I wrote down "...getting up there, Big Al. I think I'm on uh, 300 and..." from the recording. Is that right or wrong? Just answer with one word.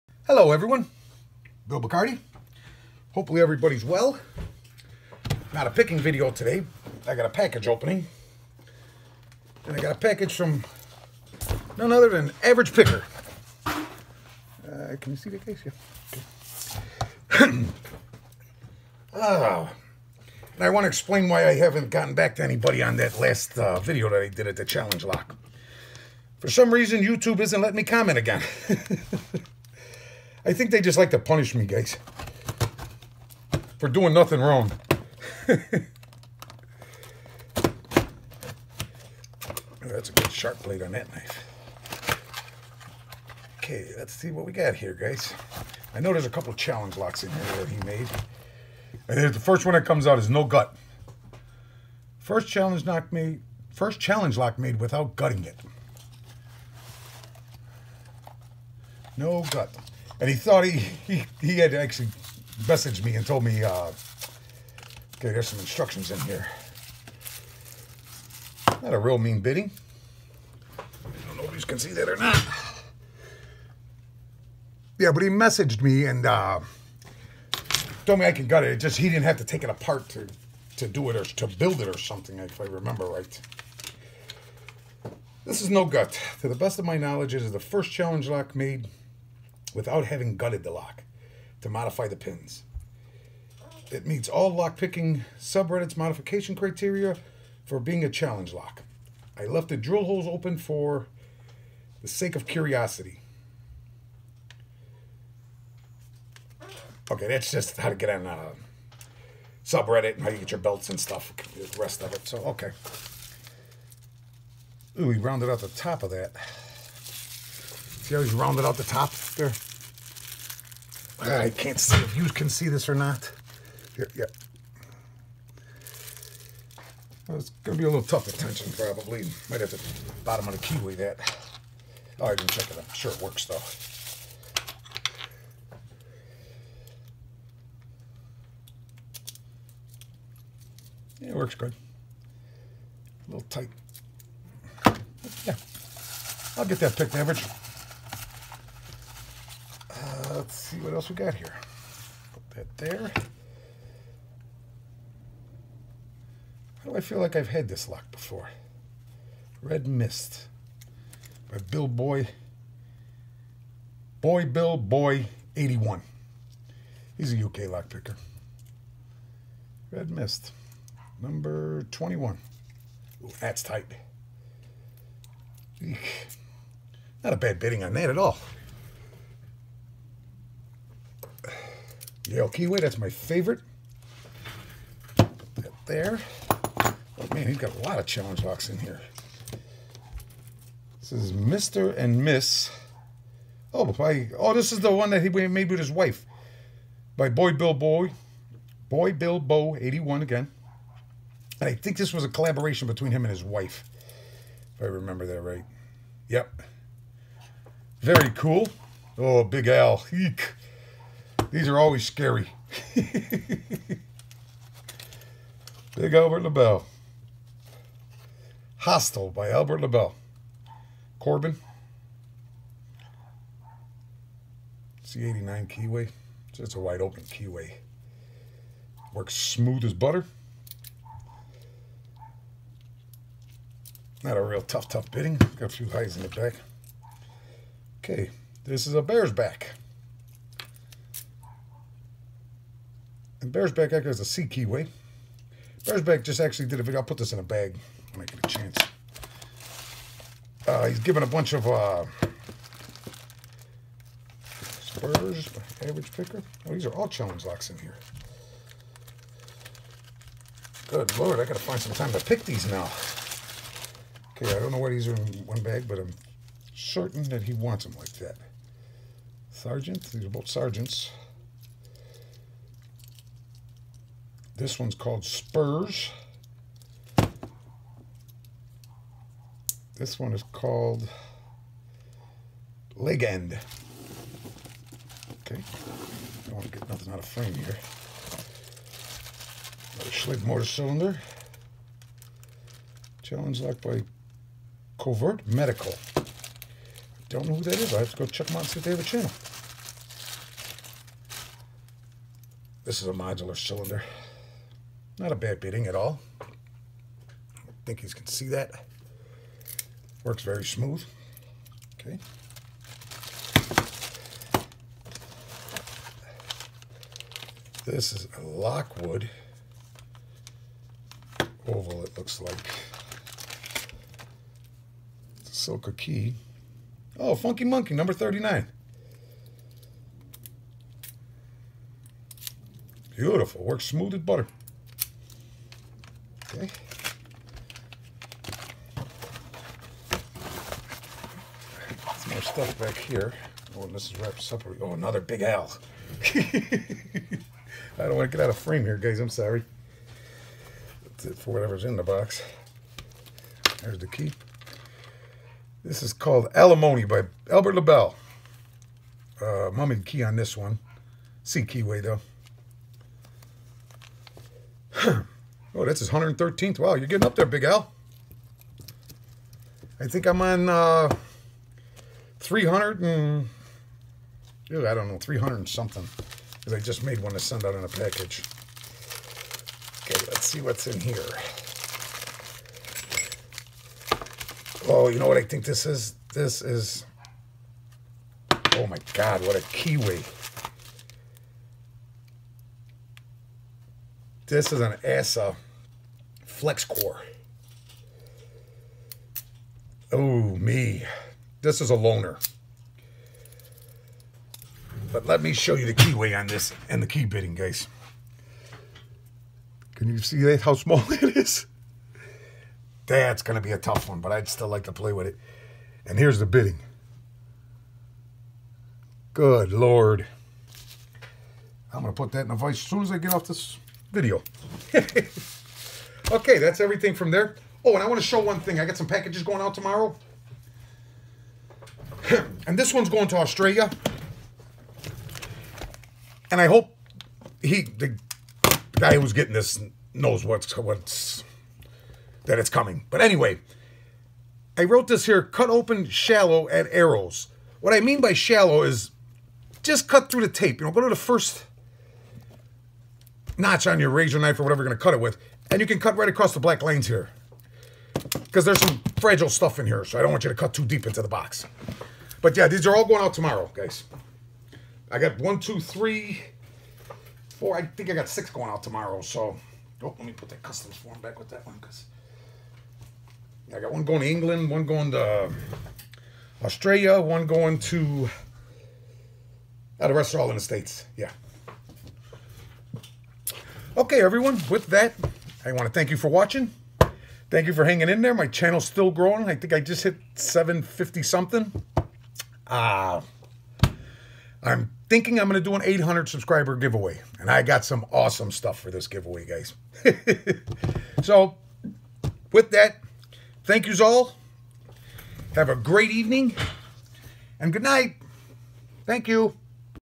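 right.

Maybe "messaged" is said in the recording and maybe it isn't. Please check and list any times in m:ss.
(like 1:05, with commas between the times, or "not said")
1:02, 1:15.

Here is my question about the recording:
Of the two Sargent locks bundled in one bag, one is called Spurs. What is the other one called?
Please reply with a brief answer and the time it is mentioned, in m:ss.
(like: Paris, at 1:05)
Leg End, at 4:42.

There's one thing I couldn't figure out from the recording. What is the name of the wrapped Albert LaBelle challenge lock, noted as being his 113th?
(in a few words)
Alimony.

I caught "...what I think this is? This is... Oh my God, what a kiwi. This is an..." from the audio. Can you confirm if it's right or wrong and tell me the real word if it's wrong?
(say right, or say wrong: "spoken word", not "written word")
right.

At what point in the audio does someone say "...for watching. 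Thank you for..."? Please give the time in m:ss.
8:06.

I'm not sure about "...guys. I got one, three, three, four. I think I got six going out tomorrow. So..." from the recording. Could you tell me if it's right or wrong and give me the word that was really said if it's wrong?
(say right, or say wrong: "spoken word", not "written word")
wrong: "two", not "three".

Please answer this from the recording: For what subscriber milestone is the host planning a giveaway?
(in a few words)
800.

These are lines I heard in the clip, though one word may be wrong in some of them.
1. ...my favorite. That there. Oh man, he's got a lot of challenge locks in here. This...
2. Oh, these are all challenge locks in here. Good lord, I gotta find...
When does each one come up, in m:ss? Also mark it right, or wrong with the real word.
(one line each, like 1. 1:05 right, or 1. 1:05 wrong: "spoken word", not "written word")
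1. 3:02 right
2. 4:16 right.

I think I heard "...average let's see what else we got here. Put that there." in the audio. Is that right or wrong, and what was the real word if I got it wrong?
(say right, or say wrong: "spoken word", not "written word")
right.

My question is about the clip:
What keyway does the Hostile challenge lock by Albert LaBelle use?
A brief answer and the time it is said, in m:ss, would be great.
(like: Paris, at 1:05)
C89, at 3:45.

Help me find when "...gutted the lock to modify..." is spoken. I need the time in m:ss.
1:30.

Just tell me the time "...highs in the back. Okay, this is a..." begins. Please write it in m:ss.
3:55.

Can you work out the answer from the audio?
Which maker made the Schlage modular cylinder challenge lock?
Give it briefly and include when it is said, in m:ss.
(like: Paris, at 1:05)
Covert Medical, at 4:54.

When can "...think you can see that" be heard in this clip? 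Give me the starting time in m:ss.
5:07.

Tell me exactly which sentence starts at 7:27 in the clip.
What I mean by shallow is just cut through the tape.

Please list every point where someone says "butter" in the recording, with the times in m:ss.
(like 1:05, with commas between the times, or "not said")
3:49, 5:34.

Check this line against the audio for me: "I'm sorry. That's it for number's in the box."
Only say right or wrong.
wrong.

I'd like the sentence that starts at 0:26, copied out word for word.
For some reason, YouTube isn't letting me comment again.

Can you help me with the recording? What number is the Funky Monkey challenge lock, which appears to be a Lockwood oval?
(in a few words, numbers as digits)
39.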